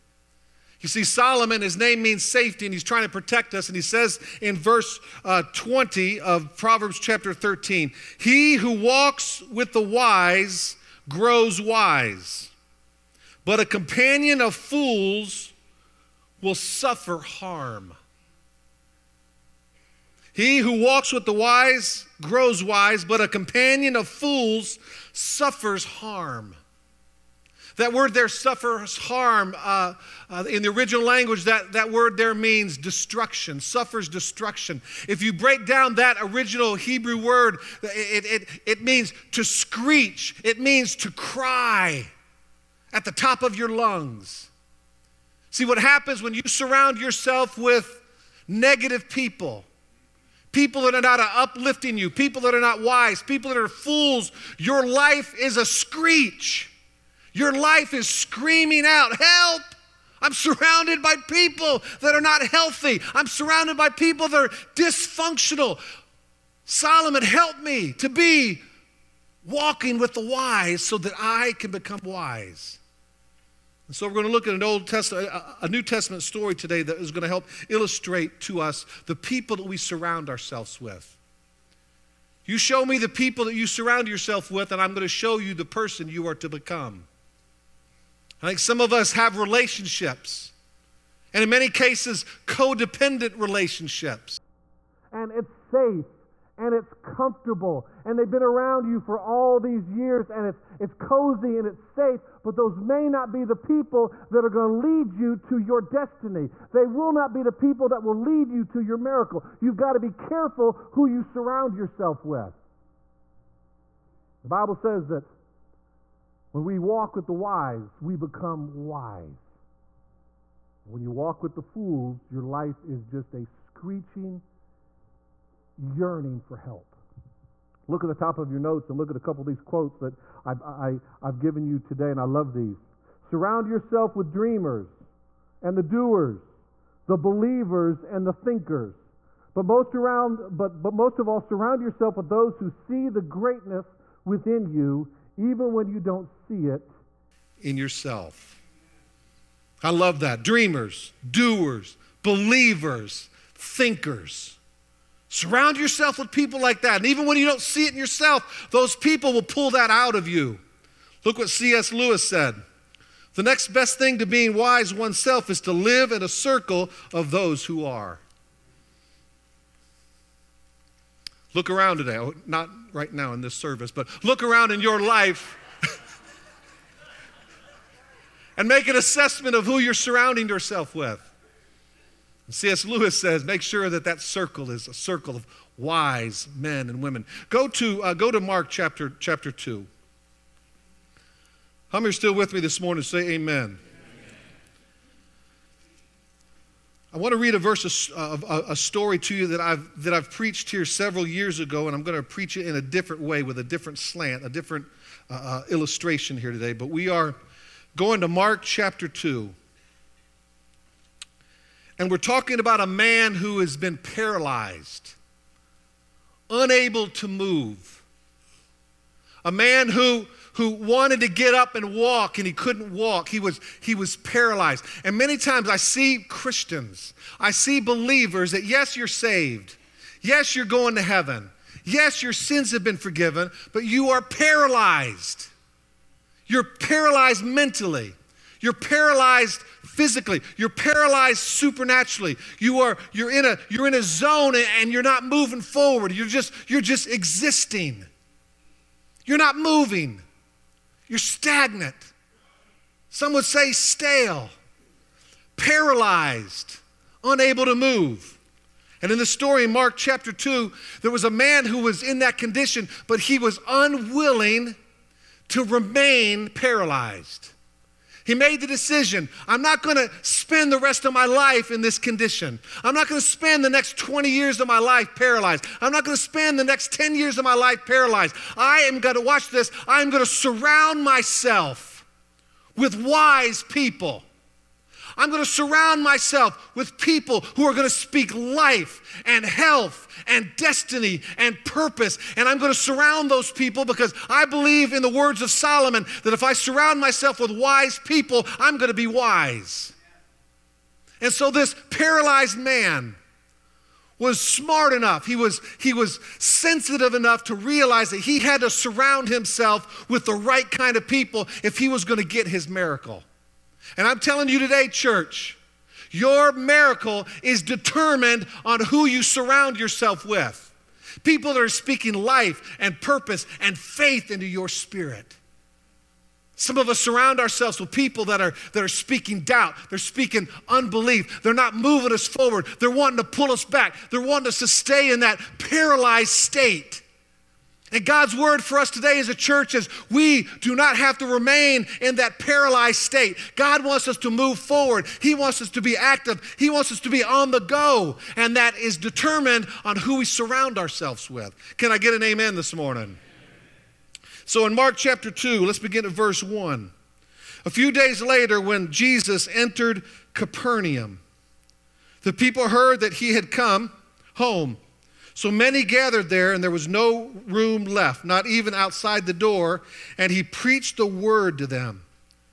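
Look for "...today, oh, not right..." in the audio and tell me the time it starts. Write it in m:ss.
2:51.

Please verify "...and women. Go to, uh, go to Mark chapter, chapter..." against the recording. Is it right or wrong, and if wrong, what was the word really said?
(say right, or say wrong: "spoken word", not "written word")
right.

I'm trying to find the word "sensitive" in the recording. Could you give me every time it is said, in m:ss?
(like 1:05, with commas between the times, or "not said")
5:06.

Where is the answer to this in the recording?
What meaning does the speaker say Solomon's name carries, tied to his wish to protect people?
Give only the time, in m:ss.
0:02.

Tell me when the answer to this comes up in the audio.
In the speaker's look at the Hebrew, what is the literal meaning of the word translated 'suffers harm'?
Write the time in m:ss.
0:39.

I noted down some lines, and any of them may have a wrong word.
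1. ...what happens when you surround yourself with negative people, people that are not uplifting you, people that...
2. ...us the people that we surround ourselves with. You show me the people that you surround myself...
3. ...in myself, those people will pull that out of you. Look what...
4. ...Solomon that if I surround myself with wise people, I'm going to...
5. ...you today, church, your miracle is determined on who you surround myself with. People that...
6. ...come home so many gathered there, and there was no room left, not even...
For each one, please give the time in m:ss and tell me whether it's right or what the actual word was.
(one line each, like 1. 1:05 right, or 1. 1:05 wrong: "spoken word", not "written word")
1. 0:45 right
2. 1:18 wrong: "yourself", not "myself"
3. 2:37 wrong: "yourself", not "myself"
4. 4:55 right
5. 5:14 wrong: "yourself", not "myself"
6. 6:03 right.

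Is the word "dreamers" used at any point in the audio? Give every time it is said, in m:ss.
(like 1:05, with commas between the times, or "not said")
2:14, 2:30.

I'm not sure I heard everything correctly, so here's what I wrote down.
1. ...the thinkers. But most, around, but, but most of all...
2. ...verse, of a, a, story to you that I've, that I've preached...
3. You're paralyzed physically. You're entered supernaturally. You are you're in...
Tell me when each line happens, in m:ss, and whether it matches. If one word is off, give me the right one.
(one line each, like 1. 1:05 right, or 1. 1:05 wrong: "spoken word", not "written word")
1. 2:18 right
2. 3:17 right
3. 3:58 wrong: "paralyzed", not "entered".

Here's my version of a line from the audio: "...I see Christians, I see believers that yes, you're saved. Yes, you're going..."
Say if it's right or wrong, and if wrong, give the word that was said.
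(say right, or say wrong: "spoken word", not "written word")
right.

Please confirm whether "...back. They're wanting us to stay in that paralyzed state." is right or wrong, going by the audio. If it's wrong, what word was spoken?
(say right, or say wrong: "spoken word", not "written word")
right.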